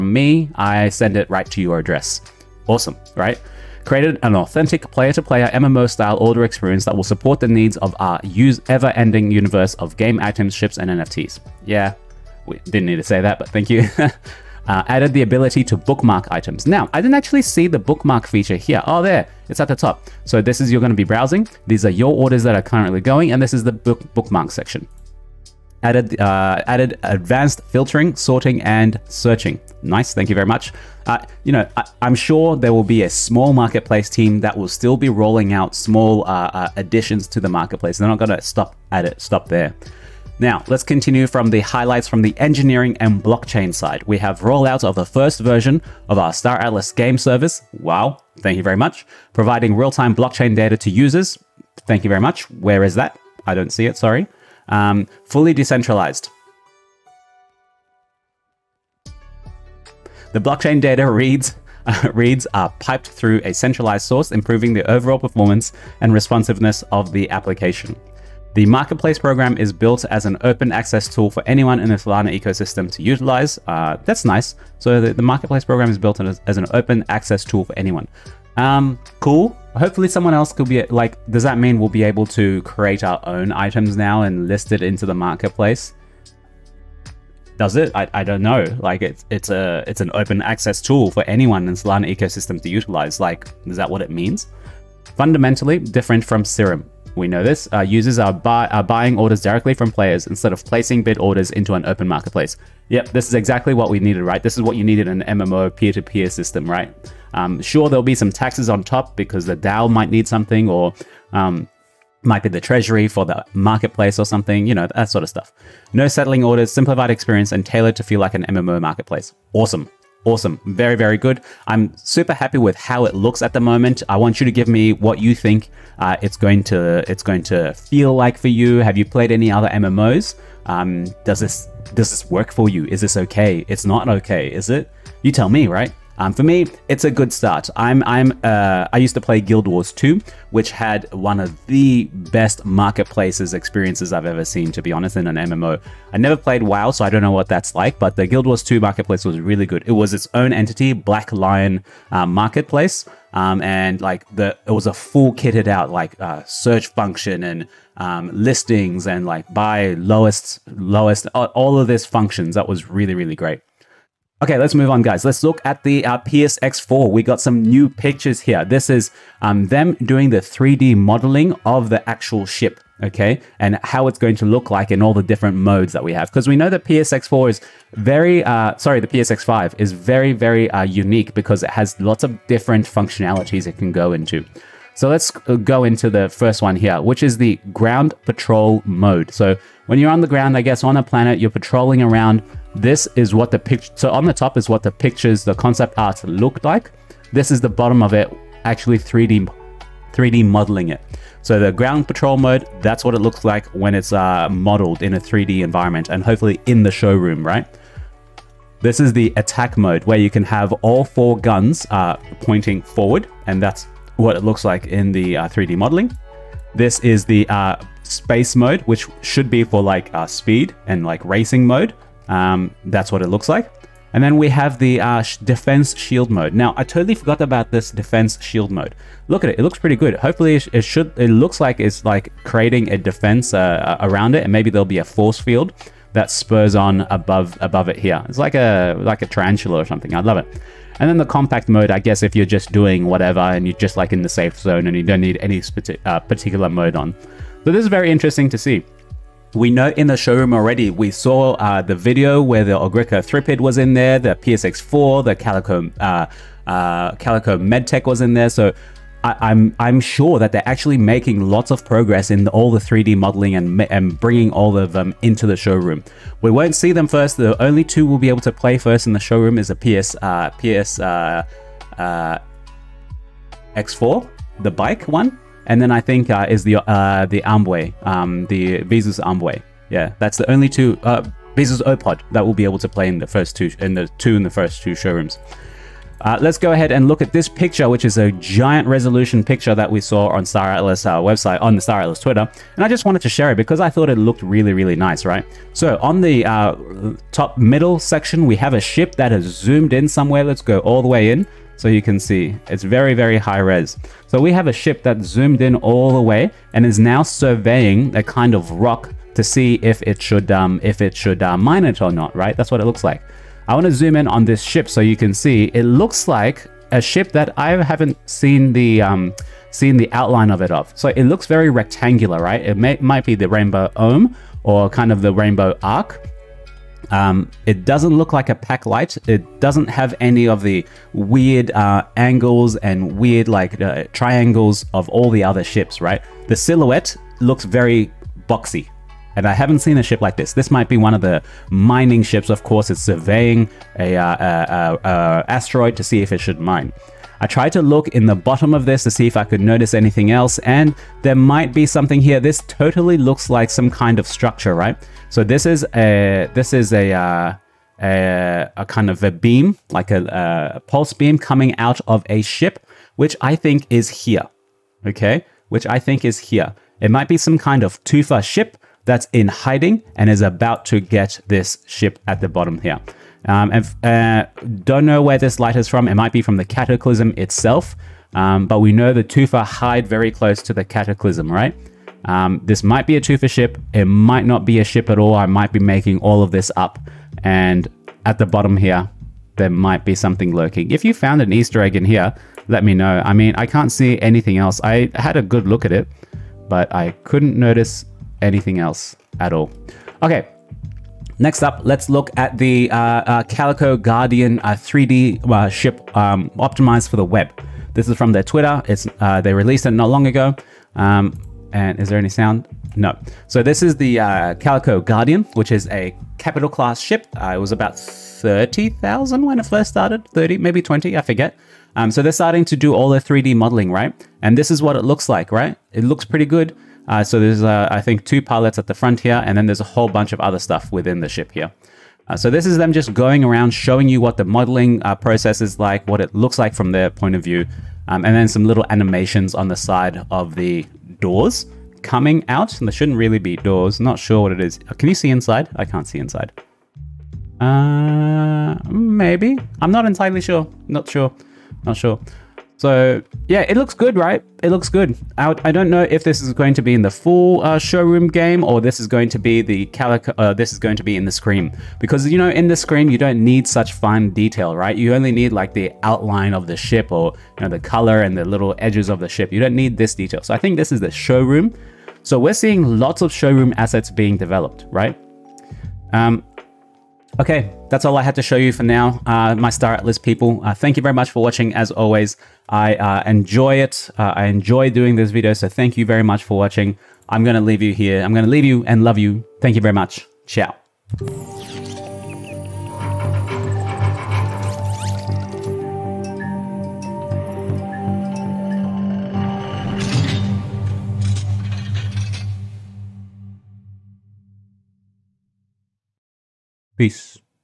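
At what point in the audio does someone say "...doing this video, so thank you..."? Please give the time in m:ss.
8:04.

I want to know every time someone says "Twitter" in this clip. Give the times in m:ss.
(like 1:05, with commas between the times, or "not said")
4:52, 6:48.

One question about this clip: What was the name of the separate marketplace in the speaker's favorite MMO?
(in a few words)
Black Lion.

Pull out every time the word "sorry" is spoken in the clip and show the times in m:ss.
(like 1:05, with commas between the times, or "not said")
0:53, 2:58.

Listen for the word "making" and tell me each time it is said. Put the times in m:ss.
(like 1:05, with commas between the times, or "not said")
4:20, 6:25.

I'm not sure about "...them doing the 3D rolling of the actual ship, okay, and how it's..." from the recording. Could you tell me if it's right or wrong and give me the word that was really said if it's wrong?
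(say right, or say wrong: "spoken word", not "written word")
wrong: "modeling", not "rolling".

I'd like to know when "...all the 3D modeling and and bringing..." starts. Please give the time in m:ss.
4:22.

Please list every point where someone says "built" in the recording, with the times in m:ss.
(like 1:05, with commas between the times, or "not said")
1:09, 1:15.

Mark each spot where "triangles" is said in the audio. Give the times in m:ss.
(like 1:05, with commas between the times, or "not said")
5:34.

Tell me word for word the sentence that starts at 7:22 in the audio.
And there shouldn't really be doors.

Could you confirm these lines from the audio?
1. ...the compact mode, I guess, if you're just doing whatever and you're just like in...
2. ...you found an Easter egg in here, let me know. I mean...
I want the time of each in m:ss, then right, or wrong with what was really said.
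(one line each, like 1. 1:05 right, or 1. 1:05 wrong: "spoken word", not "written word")
1. 4:01 right
2. 6:31 right.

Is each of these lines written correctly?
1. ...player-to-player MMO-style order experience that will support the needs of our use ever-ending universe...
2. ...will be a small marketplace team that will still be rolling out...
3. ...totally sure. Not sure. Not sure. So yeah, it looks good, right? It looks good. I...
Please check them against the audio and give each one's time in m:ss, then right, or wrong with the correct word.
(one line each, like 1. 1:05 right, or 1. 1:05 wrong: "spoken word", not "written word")
1. 0:04 right
2. 0:32 right
3. 7:30 wrong: "entirely", not "totally".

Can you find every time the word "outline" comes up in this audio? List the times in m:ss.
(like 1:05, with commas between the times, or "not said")
5:20, 7:46.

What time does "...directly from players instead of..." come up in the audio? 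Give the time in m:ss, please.
1:39.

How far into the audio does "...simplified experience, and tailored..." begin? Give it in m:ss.
1:56.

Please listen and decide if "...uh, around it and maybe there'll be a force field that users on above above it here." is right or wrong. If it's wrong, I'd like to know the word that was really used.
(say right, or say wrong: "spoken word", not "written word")
wrong: "spurs", not "users".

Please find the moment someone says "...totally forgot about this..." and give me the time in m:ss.
3:46.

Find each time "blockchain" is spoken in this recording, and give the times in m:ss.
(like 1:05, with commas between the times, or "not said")
0:43, 0:50, 1:00.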